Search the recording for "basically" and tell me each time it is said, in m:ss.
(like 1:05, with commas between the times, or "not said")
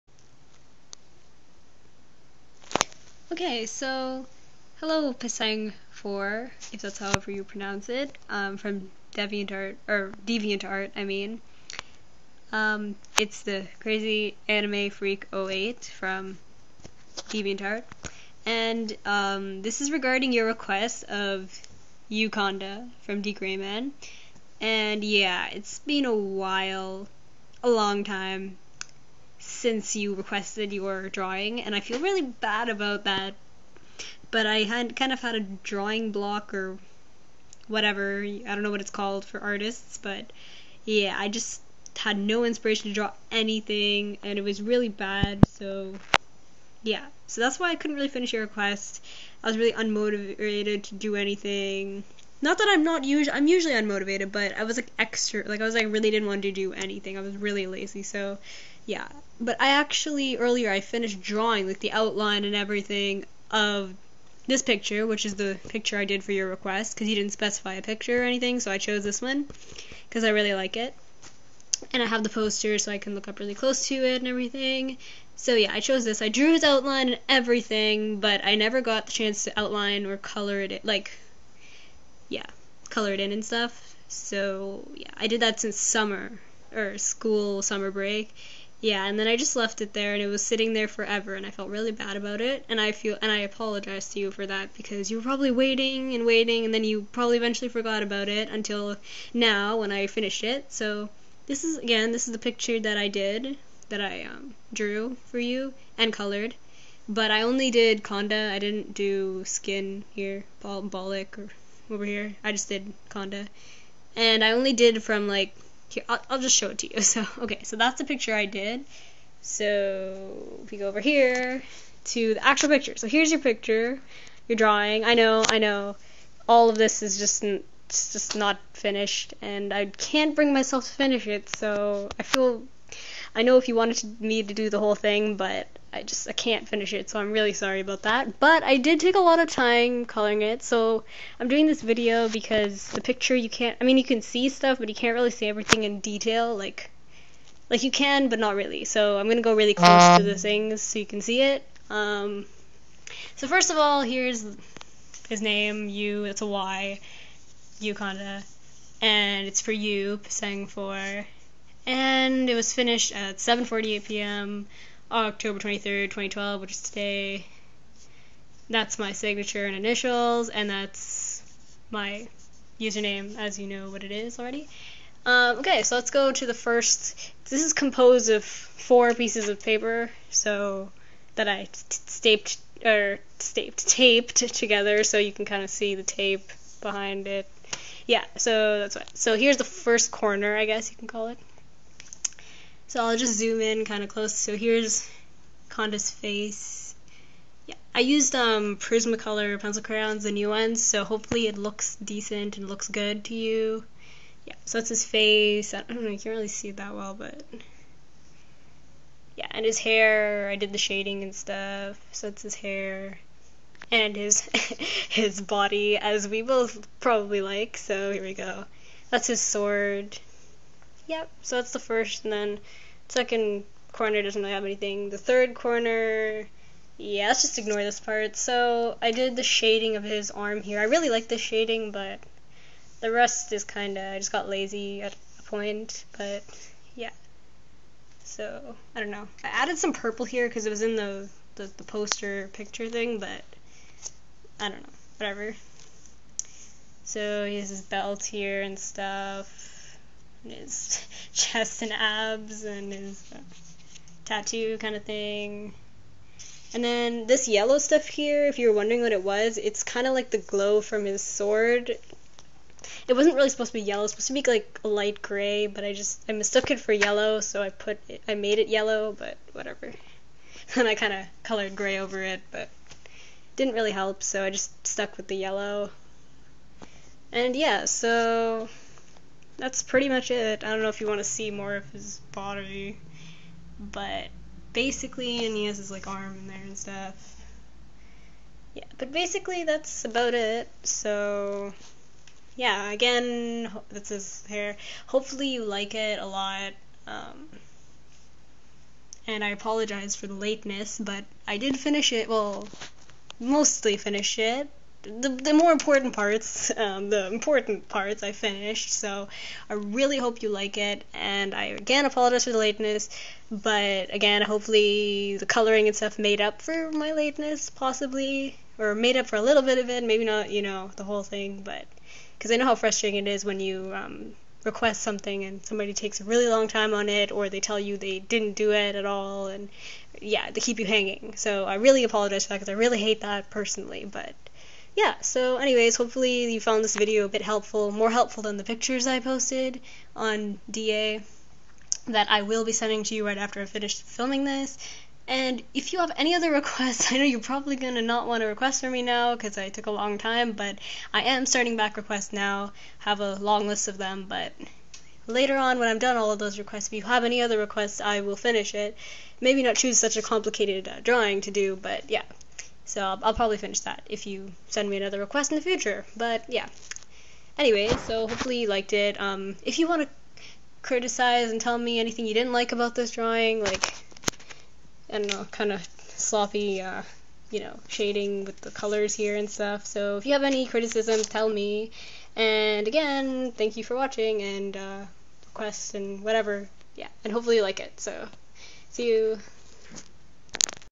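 4:44, 4:49.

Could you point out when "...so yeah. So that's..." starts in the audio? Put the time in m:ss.
0:45.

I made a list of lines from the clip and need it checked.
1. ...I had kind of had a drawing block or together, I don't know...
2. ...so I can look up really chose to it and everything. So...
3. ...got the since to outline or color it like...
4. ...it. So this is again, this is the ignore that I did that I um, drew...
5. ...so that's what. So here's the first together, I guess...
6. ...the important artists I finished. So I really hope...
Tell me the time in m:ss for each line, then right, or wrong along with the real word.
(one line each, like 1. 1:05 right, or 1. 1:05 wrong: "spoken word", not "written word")
1. 0:34 wrong: "whatever", not "together"
2. 1:12 wrong: "close", not "chose"
3. 1:18 wrong: "chance", not "since"
4. 1:40 wrong: "picture", not "ignore"
5. 3:08 wrong: "corner", not "together"
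6. 5:07 wrong: "parts", not "artists".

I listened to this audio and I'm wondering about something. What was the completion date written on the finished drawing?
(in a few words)
October 23rd, 2012.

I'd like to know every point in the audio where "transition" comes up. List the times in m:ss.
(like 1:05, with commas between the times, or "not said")
not said.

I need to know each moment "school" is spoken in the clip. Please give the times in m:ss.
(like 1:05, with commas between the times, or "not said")
1:26.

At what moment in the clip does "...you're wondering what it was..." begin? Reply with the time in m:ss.
4:18.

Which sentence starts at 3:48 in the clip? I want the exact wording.
So I did the shading of his arm here.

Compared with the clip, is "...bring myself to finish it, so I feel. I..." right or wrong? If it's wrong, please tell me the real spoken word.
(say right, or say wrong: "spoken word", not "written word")
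right.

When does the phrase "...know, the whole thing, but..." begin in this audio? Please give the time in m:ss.
5:20.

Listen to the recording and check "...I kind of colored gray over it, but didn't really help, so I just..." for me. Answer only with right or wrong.
right.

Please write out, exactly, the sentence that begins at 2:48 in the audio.
That's my signature and initials, and that's my username, as you know what it is already.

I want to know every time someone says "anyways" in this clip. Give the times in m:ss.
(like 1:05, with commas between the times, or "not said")
5:35, 6:07.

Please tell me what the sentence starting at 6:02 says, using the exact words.
So I'll, I'll probably finish that if you send me another request in the future.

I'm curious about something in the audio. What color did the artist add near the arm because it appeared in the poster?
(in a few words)
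Purple.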